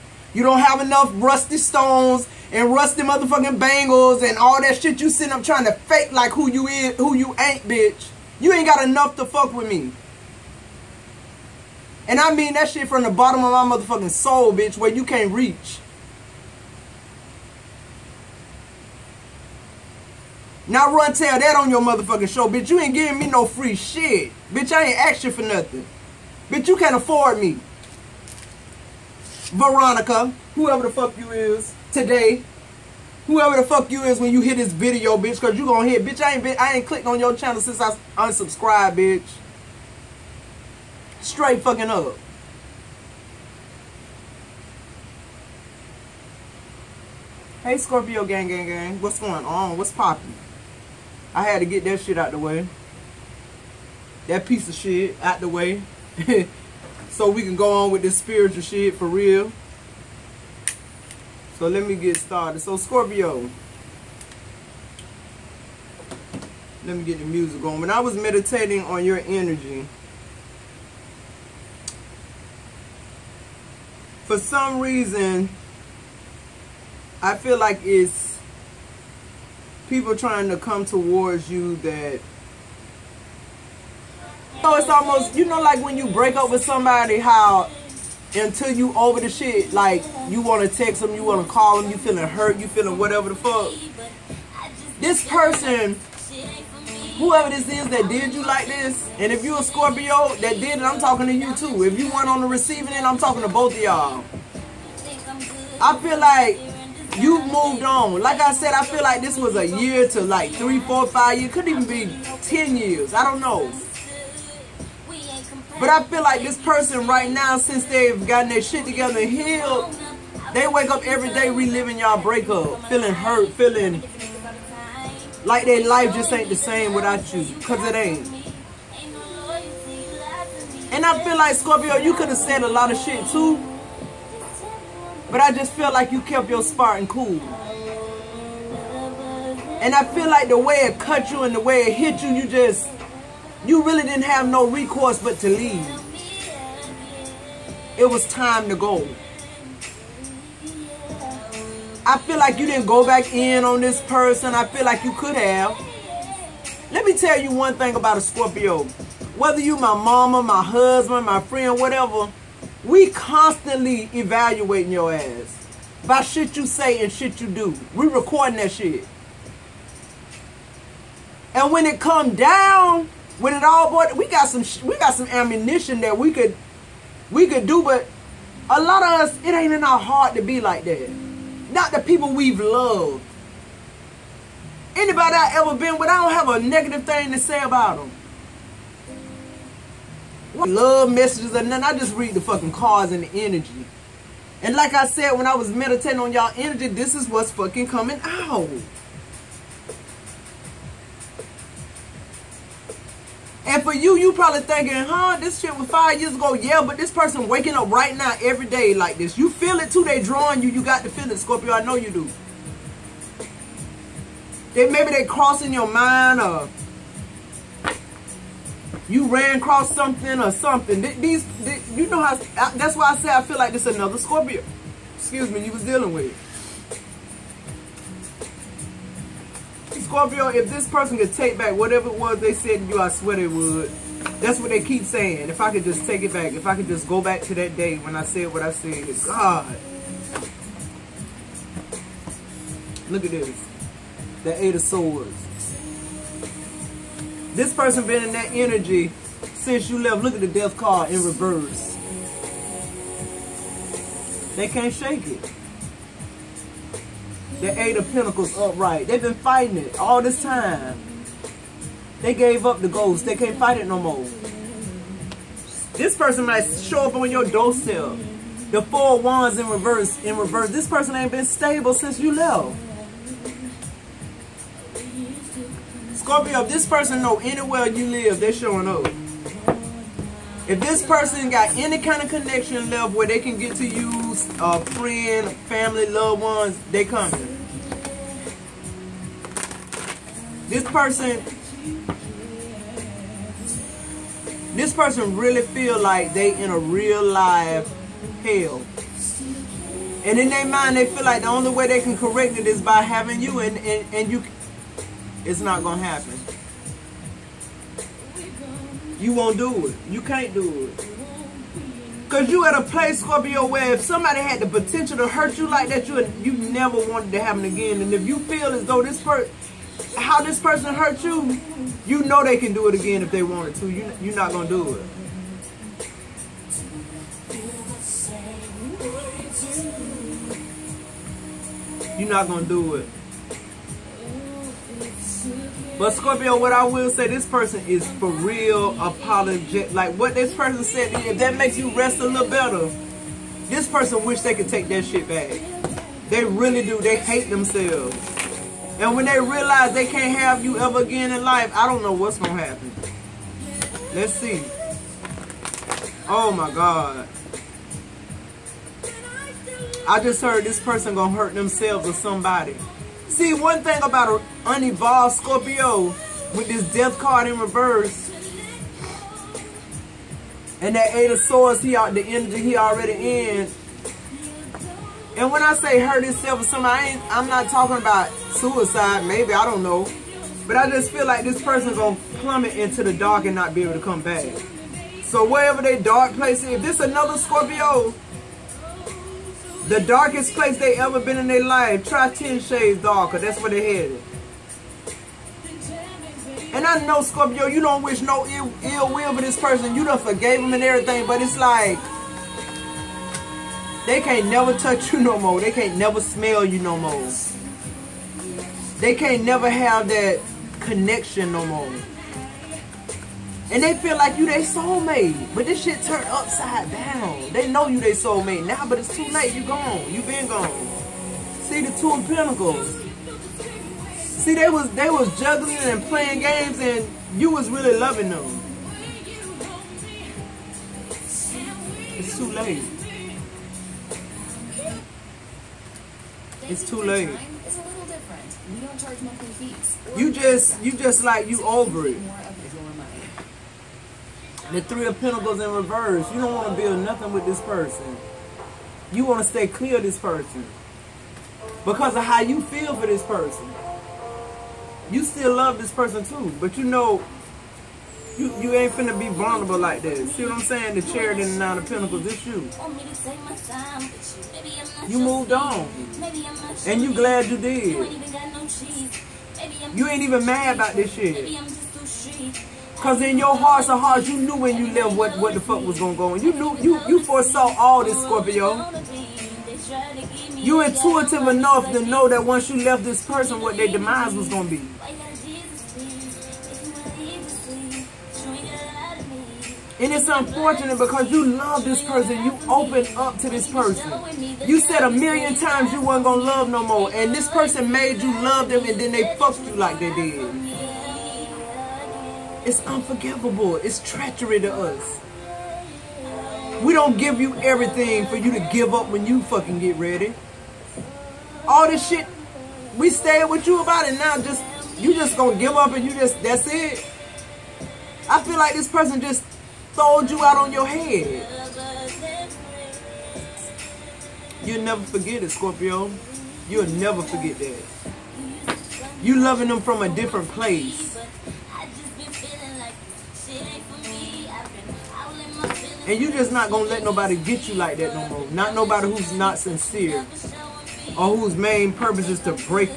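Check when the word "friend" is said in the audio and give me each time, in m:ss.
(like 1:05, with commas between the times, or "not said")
2:41, 4:44.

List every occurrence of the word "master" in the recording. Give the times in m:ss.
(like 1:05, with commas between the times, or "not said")
not said.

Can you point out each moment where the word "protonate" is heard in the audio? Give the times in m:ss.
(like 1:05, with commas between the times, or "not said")
not said.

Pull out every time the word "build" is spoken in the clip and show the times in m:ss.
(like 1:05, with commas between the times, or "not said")
7:26.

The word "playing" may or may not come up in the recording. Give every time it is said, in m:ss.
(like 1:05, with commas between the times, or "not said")
7:06.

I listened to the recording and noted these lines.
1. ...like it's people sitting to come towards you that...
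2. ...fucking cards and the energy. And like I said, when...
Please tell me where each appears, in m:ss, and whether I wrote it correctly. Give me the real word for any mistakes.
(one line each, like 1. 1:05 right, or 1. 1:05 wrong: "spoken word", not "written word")
1. 1:17 wrong: "trying", not "sitting"
2. 3:12 right.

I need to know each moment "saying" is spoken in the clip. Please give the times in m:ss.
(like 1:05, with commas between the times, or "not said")
3:55, 7:40.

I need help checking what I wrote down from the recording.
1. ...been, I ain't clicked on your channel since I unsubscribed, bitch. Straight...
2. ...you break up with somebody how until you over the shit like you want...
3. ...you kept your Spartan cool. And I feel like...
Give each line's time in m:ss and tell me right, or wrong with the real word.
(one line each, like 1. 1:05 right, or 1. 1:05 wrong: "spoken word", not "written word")
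1. 0:36 right
2. 1:25 right
3. 2:16 right.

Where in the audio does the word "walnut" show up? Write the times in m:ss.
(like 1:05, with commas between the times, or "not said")
not said.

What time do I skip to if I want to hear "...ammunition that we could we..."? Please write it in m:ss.
2:55.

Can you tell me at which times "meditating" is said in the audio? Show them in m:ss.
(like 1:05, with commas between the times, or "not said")
1:08, 3:15.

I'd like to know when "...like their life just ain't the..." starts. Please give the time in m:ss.
2:05.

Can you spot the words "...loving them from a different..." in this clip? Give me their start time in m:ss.
8:49.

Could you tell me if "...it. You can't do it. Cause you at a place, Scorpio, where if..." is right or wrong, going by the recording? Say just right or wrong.
right.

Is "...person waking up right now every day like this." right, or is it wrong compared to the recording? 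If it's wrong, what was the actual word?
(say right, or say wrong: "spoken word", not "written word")
right.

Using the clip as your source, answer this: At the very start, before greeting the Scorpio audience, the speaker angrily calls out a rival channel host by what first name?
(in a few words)
Veronica.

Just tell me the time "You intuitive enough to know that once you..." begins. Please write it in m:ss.
8:00.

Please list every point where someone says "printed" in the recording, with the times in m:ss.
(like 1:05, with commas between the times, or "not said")
not said.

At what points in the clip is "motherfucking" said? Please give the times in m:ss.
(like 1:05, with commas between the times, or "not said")
0:03, 0:13, 0:21.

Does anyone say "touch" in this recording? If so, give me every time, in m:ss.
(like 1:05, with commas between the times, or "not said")
6:44.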